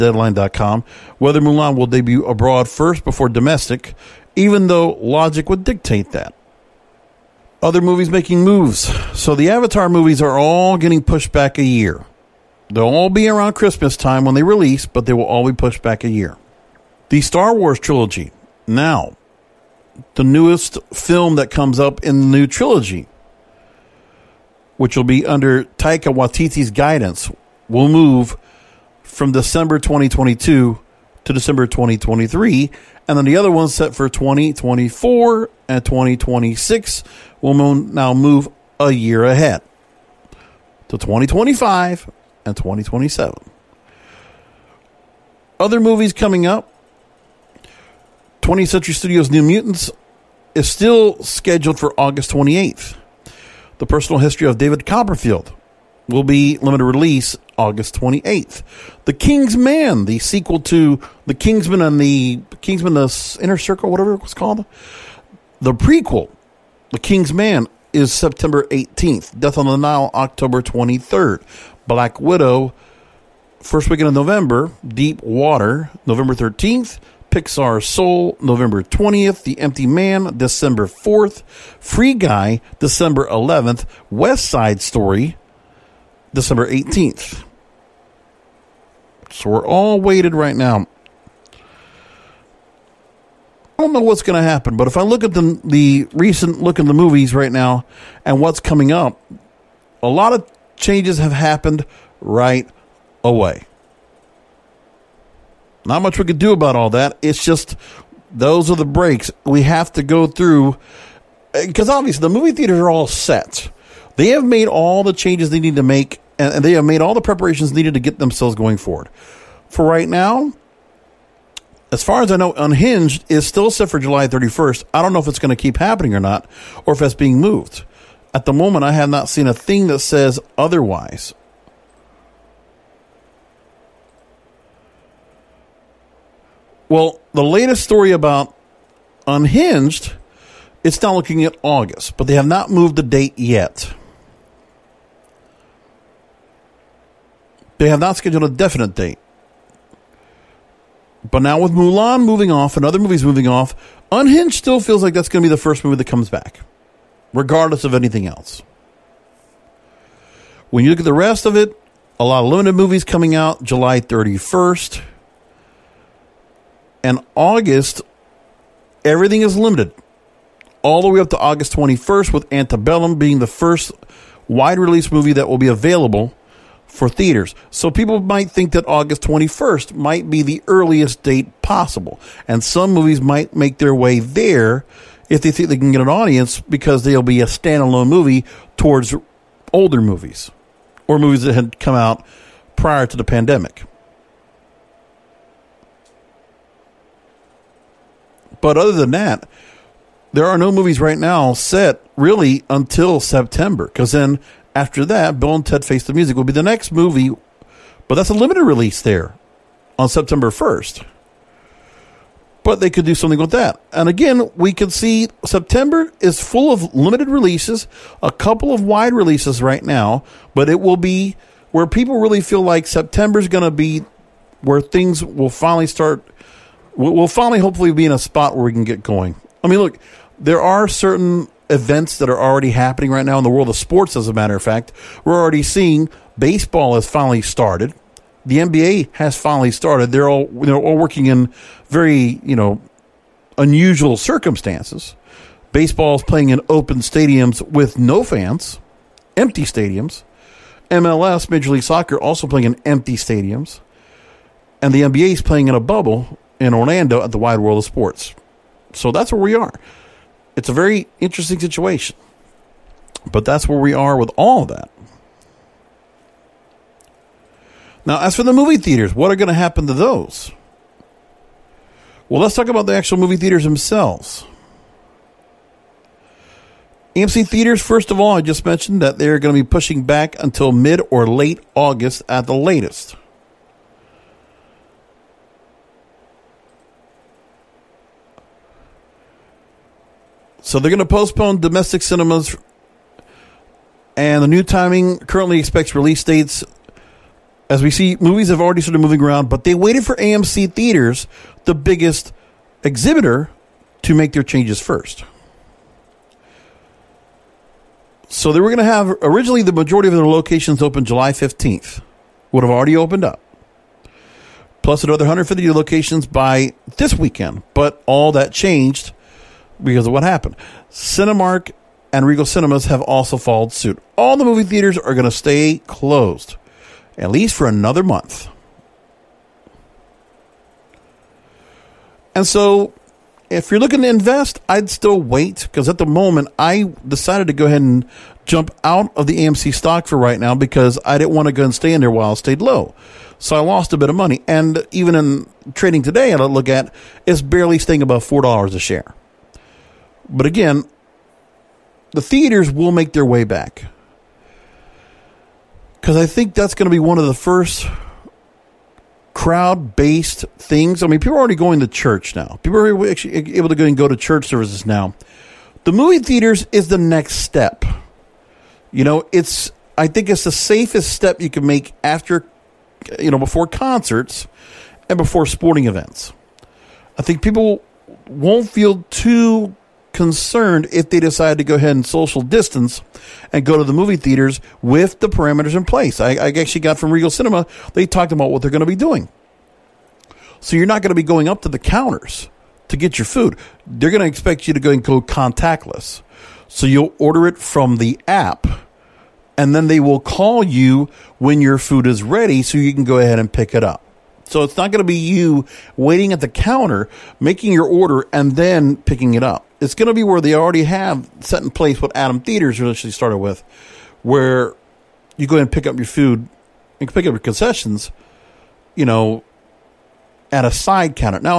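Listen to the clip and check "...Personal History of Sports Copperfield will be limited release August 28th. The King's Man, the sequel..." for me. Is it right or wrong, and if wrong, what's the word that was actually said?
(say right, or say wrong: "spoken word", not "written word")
wrong: "David", not "Sports".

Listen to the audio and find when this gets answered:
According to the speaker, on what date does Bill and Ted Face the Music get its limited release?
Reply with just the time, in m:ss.
3:30.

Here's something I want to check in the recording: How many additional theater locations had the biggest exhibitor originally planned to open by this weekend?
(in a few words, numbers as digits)
150.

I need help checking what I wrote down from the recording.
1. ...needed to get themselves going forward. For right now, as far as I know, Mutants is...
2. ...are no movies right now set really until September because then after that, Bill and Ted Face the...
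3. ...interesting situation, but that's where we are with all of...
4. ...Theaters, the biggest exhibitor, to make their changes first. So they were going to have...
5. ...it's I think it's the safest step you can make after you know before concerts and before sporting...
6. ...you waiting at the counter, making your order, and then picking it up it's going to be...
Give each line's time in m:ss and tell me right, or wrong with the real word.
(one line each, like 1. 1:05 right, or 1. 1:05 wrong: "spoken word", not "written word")
1. 1:57 wrong: "Unhinged", not "Mutants"
2. 3:20 right
3. 4:21 right
4. 5:00 right
5. 6:09 right
6. 6:45 right.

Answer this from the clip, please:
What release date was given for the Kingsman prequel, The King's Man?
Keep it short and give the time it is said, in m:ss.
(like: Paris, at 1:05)
September 18th, at 1:08.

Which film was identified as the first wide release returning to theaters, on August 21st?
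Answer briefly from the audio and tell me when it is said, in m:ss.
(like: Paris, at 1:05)
Antebellum, at 2:52.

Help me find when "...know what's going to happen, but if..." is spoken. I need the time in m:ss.
1:33.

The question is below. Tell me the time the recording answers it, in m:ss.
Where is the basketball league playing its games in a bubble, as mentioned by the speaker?
4:17.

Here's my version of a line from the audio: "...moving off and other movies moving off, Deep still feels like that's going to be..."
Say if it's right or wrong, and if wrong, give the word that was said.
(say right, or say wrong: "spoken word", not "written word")
wrong: "Unhinged", not "Deep".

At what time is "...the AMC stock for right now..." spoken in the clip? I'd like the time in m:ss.
5:39.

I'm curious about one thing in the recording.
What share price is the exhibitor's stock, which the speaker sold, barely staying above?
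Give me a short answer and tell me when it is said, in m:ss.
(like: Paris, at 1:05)
$4, at 5:48.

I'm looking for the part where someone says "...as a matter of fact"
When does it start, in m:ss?
3:54.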